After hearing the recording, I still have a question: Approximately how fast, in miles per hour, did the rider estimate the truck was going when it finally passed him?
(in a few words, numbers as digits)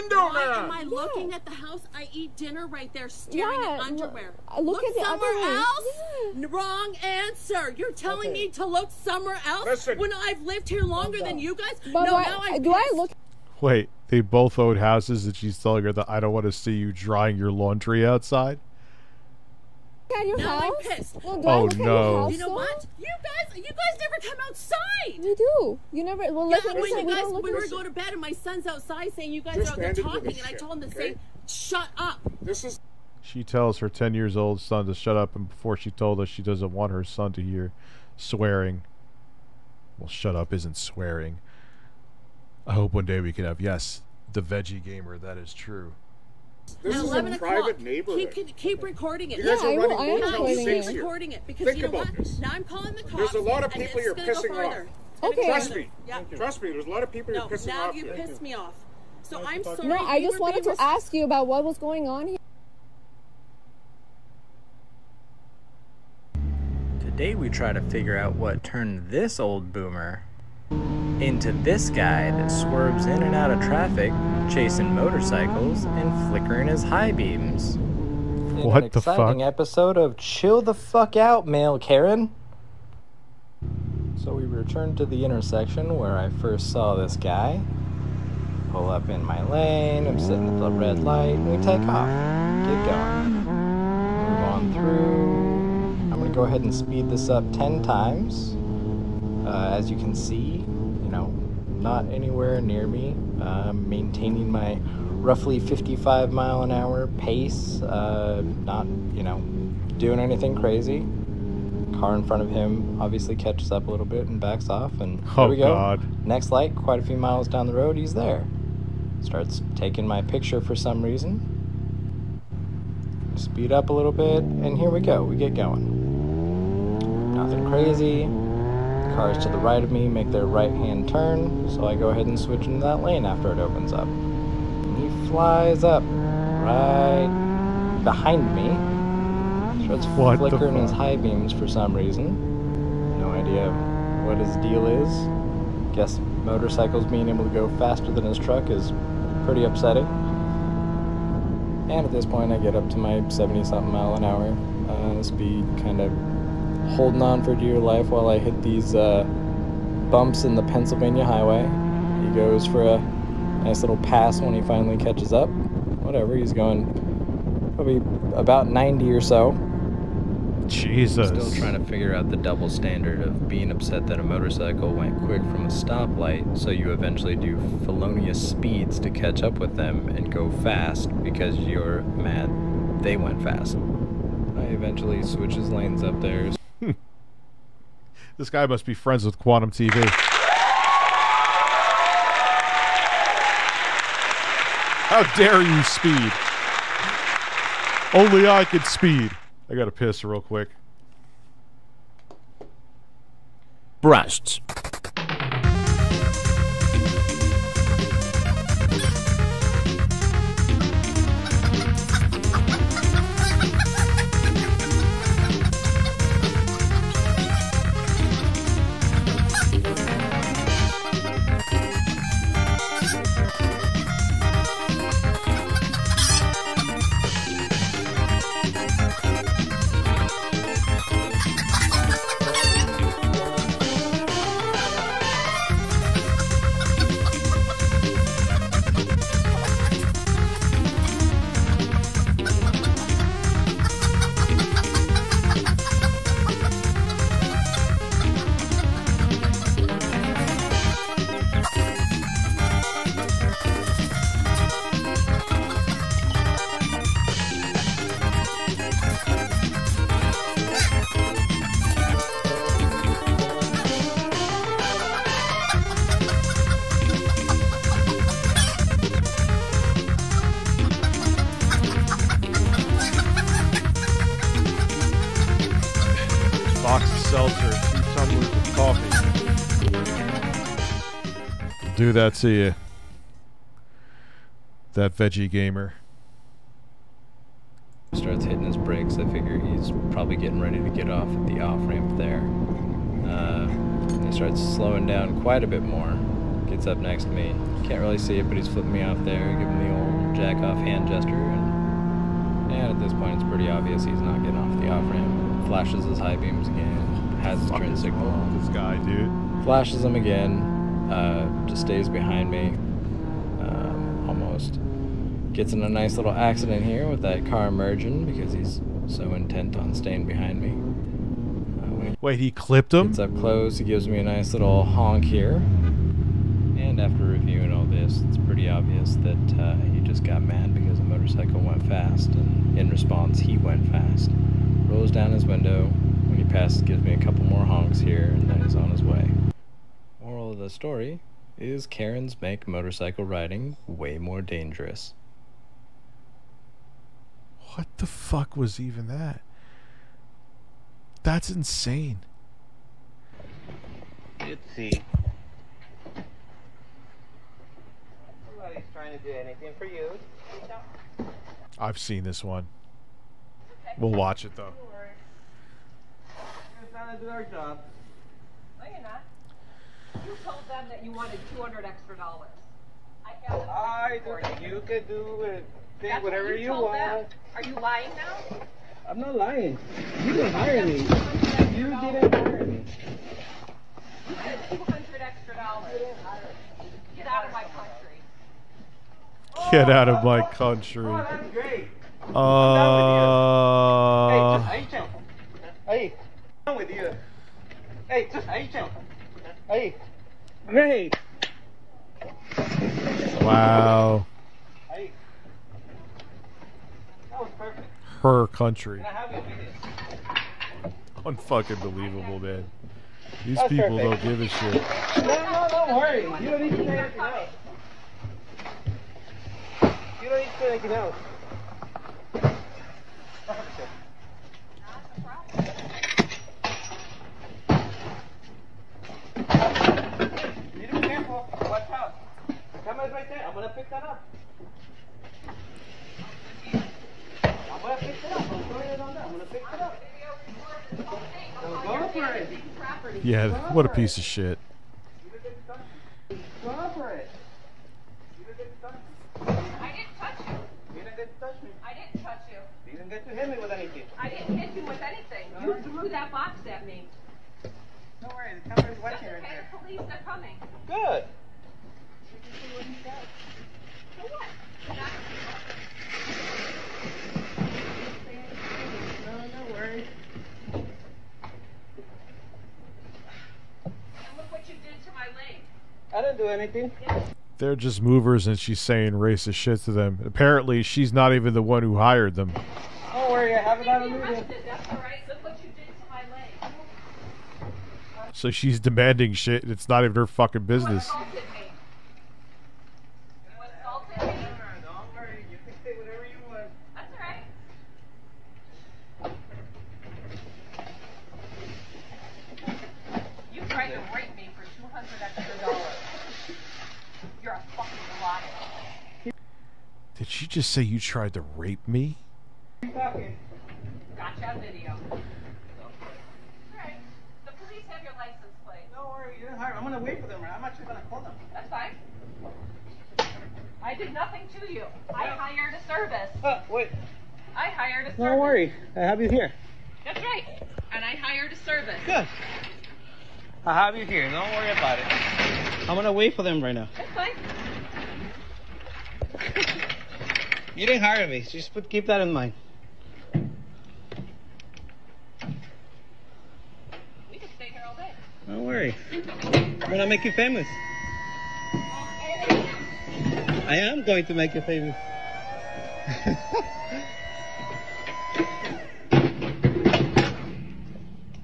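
90.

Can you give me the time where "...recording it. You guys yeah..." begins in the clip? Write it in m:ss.
0:48.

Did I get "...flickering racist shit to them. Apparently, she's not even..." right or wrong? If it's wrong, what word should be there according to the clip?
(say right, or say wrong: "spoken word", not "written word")
wrong: "saying", not "flickering".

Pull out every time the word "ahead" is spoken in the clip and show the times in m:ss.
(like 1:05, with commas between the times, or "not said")
1:36, 2:12.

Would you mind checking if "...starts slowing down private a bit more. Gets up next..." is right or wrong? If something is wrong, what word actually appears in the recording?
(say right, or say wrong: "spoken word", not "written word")
wrong: "quite", not "private".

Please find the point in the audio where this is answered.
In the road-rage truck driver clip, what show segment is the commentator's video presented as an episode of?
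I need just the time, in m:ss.
1:20.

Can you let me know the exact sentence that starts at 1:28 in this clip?
Pull up in my lane, I'm sitting at the red light, and we take off.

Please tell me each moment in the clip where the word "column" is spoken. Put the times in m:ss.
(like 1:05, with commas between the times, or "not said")
not said.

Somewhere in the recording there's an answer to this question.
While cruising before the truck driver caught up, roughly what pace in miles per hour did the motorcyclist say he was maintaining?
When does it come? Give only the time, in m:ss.
1:45.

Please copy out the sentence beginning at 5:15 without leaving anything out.
Gets in a nice little accident here with that car merging because he's so intent on staying behind me.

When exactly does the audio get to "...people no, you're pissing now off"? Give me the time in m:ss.
0:57.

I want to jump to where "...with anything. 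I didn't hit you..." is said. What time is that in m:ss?
7:33.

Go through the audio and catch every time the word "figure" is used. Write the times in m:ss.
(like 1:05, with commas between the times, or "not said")
1:07, 2:51, 4:49.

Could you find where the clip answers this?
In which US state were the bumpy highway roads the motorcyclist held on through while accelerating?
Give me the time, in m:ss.
2:40.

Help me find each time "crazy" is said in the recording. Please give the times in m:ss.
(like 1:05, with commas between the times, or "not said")
1:50, 2:07.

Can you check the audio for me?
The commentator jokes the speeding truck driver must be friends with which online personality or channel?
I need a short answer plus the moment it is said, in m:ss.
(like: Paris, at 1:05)
Quantum TV, at 3:09.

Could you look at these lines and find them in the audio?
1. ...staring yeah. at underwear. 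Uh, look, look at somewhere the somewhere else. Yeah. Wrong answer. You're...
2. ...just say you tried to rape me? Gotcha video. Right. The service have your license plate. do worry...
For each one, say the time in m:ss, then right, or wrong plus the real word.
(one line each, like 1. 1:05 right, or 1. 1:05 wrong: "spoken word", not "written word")
1. 0:03 right
2. 8:30 wrong: "police", not "service".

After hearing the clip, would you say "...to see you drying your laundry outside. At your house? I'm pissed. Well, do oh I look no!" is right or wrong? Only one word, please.
right.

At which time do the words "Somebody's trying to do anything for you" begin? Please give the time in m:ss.
5:58.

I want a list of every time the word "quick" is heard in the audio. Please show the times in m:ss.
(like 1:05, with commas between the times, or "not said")
2:55, 3:20.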